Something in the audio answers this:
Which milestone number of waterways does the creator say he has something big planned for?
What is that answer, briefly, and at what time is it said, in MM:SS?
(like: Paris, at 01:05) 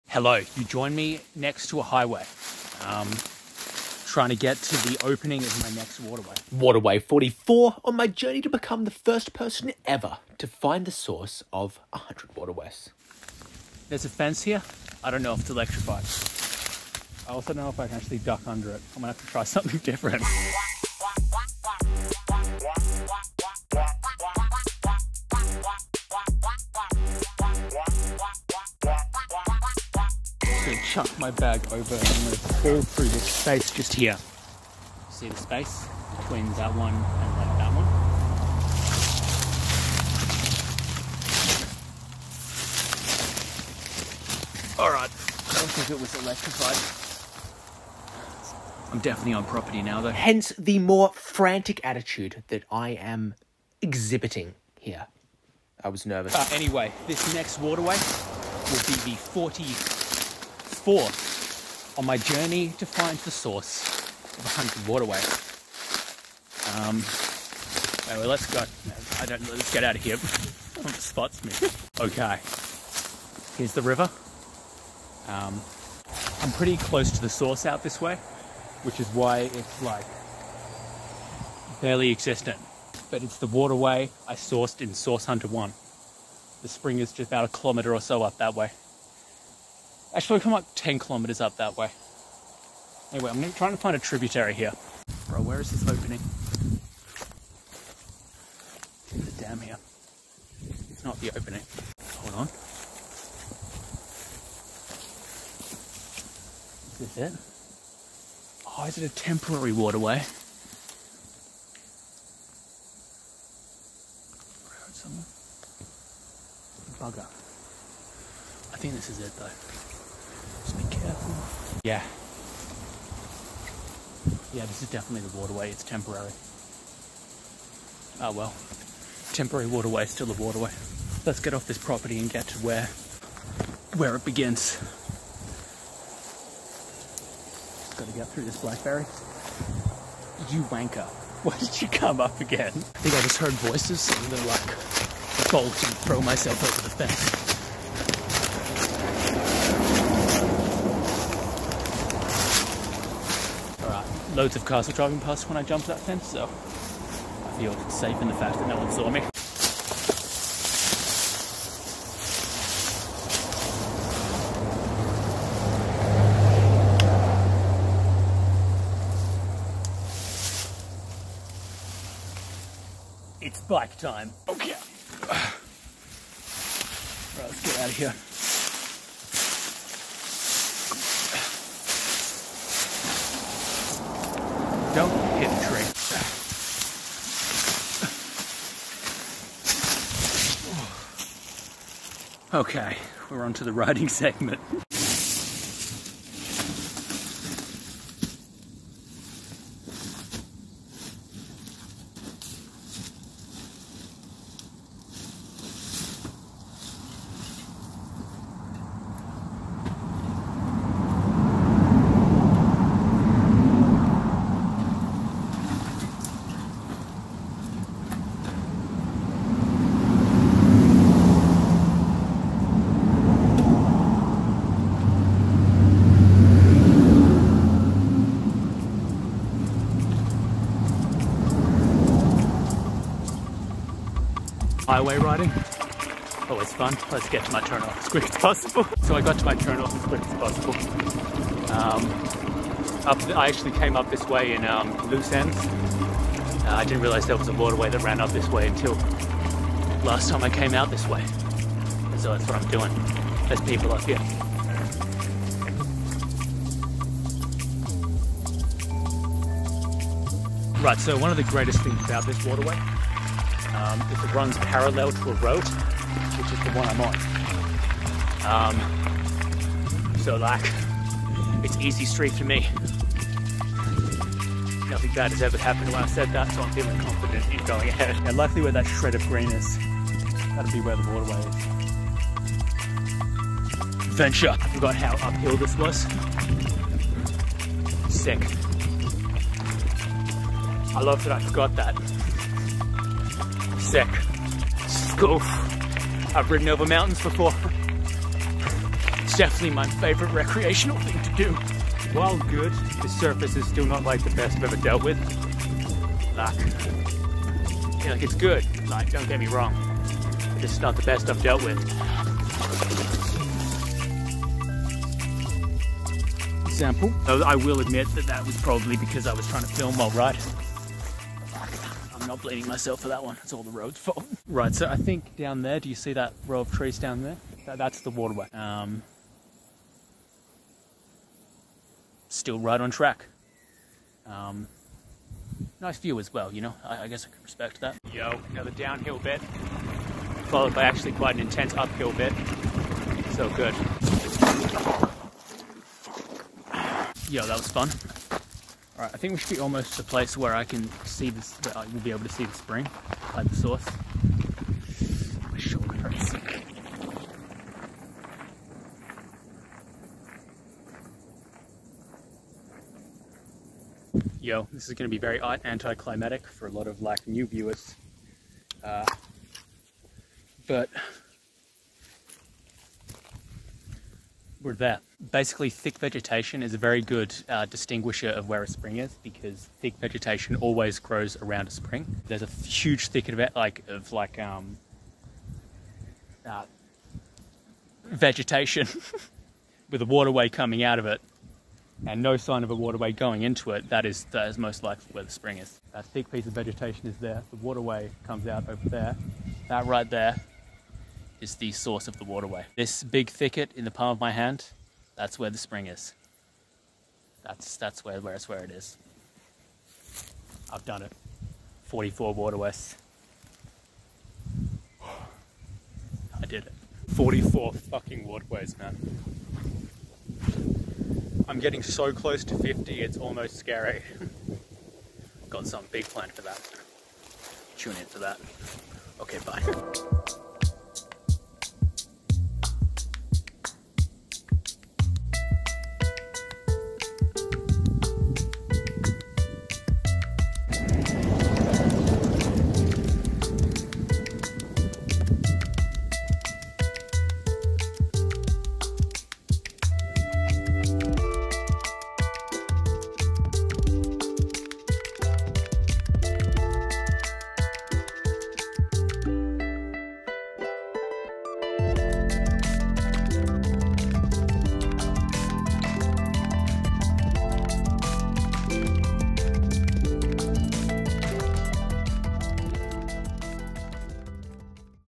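50, at 07:02.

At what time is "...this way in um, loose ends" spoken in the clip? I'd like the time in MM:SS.
04:04.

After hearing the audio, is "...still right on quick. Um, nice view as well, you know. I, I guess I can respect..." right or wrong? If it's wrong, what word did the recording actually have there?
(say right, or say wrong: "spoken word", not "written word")
wrong: "track", not "quick".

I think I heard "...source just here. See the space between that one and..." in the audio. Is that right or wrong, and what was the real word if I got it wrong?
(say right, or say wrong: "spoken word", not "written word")
wrong: "space", not "source".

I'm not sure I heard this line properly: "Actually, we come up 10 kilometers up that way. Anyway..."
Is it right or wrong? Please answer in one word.
right.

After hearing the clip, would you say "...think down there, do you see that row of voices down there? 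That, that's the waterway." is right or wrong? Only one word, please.
wrong.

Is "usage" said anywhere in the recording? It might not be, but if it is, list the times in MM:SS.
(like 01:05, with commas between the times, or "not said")
not said.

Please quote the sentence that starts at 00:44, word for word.
Alright, I don't think it was electrified.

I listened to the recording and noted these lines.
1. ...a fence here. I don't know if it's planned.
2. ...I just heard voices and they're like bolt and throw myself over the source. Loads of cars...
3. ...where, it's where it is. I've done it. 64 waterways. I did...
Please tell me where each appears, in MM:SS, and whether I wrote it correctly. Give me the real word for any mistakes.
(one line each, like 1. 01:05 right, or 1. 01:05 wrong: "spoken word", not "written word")
1. 00:14 wrong: "electrified", not "planned"
2. 02:23 wrong: "fence", not "source"
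3. 06:48 wrong: "44", not "64".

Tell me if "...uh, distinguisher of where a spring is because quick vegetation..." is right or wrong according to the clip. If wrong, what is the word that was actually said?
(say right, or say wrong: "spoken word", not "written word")
wrong: "thick", not "quick".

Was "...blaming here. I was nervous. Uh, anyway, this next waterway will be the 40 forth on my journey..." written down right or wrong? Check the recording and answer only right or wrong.
wrong.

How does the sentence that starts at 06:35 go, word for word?
That thick piece of vegetation is there.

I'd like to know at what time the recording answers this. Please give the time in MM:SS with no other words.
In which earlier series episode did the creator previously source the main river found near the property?
01:24.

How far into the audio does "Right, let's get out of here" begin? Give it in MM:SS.
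02:54.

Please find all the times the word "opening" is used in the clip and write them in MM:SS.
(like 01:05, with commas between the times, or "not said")
00:05, 01:35, 01:41.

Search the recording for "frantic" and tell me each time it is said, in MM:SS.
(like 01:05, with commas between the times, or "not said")
00:51.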